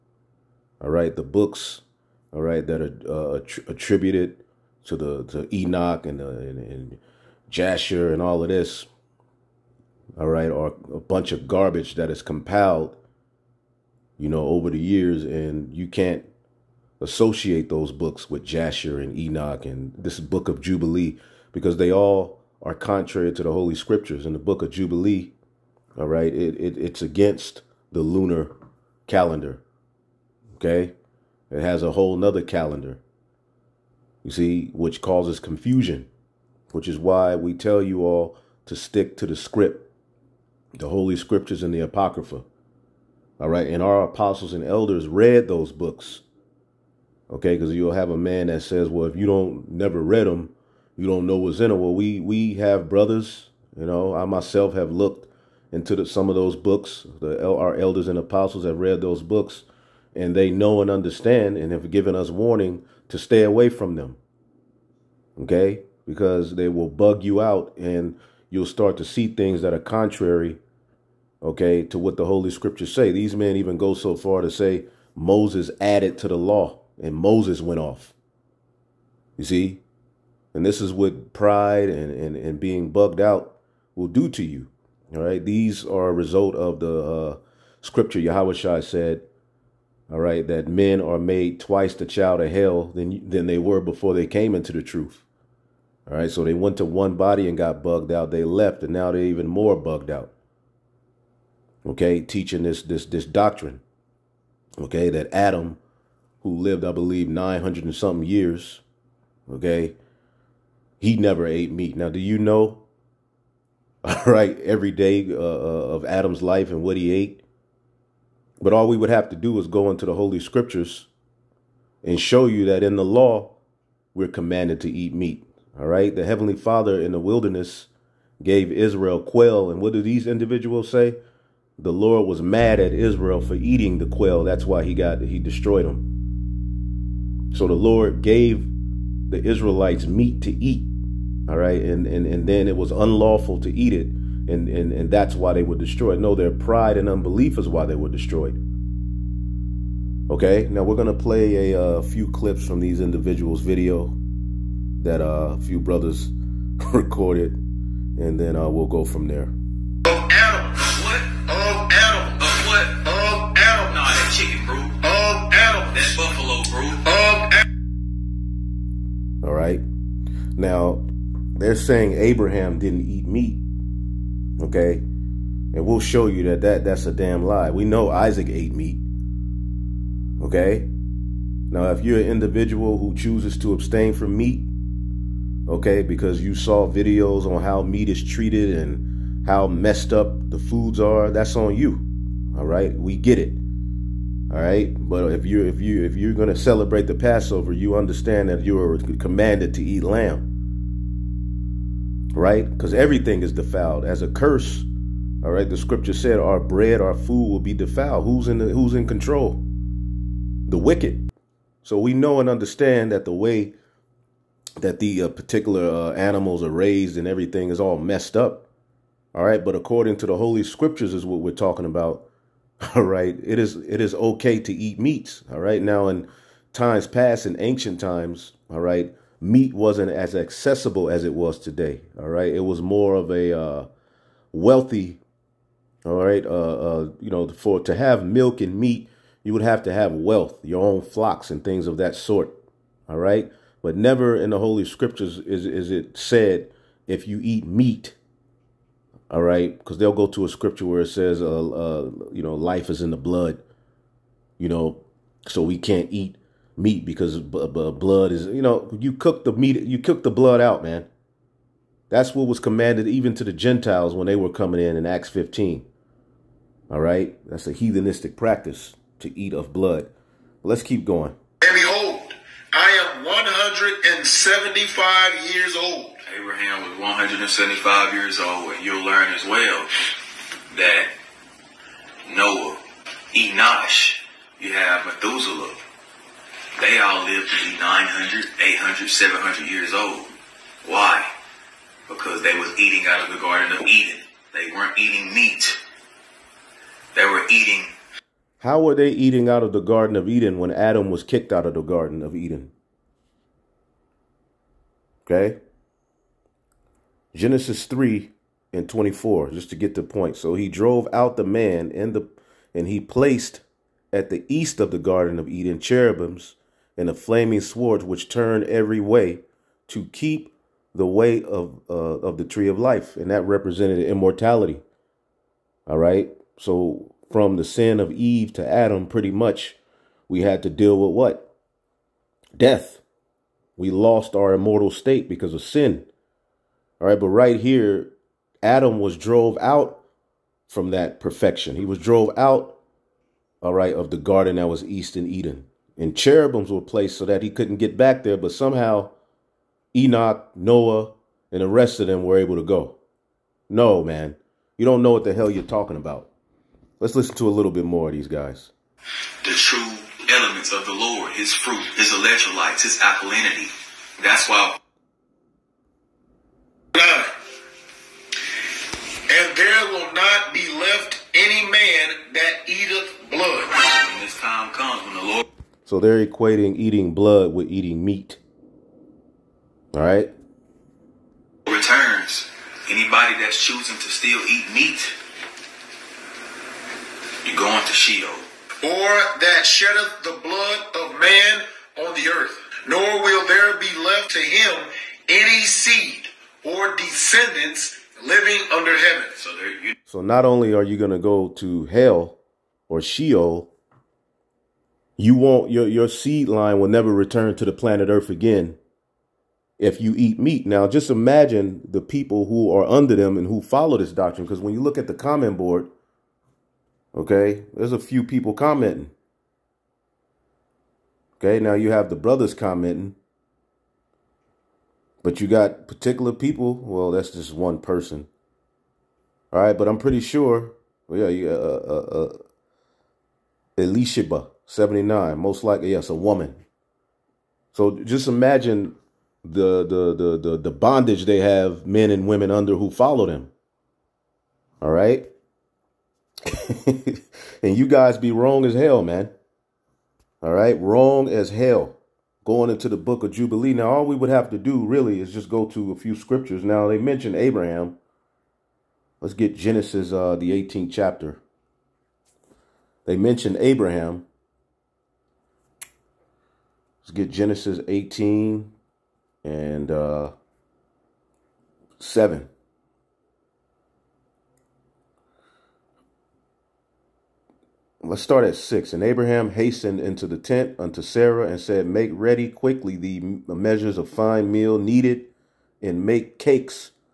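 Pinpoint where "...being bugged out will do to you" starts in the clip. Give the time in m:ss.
1:22.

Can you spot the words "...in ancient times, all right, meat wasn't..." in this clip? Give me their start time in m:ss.
3:47.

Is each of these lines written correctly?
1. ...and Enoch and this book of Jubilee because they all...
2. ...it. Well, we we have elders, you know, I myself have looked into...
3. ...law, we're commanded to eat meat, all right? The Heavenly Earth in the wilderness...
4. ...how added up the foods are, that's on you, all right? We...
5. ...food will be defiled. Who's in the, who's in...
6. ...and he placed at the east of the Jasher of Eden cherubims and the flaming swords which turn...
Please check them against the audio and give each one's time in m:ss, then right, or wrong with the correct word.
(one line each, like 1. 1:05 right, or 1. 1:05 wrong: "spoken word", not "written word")
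1. 0:18 right
2. 0:51 wrong: "brothers", not "elders"
3. 2:03 wrong: "Father", not "Earth"
4. 3:09 wrong: "messed", not "added"
5. 3:27 right
6. 5:12 wrong: "Garden", not "Jasher".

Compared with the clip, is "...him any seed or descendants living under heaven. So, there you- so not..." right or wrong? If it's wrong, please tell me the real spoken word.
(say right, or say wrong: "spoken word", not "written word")
right.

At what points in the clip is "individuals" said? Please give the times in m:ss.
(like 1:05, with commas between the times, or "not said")
2:10, 2:33, 3:02.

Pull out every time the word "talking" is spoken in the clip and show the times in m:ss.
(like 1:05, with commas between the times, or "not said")
3:41, 5:55.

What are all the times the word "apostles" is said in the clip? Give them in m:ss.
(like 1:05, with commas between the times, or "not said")
0:44, 0:58.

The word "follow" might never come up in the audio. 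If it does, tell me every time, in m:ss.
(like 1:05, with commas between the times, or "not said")
6:53, 7:22.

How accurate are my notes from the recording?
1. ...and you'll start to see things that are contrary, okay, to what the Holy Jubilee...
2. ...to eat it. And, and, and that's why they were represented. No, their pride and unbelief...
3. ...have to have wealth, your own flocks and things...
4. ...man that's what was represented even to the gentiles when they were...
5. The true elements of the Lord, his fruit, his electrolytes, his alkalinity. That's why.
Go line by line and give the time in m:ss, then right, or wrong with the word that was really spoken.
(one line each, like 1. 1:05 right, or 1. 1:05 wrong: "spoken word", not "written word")
1. 1:07 wrong: "Scriptures", not "Jubilee"
2. 2:23 wrong: "destroyed", not "represented"
3. 3:59 right
4. 4:20 wrong: "commanded", not "represented"
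5. 5:59 right.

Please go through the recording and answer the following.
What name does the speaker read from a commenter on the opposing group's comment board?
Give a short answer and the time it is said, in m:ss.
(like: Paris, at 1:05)
Elisheba, at 7:13.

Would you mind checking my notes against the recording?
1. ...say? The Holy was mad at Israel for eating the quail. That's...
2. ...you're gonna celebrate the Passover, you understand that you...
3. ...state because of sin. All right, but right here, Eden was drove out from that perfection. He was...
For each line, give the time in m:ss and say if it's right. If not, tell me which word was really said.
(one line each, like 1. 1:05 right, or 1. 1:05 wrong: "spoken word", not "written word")
1. 2:10 wrong: "Lord", not "Holy"
2. 3:16 right
3. 5:34 wrong: "Adam", not "Eden".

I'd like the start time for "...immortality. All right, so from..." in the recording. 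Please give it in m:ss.
5:23.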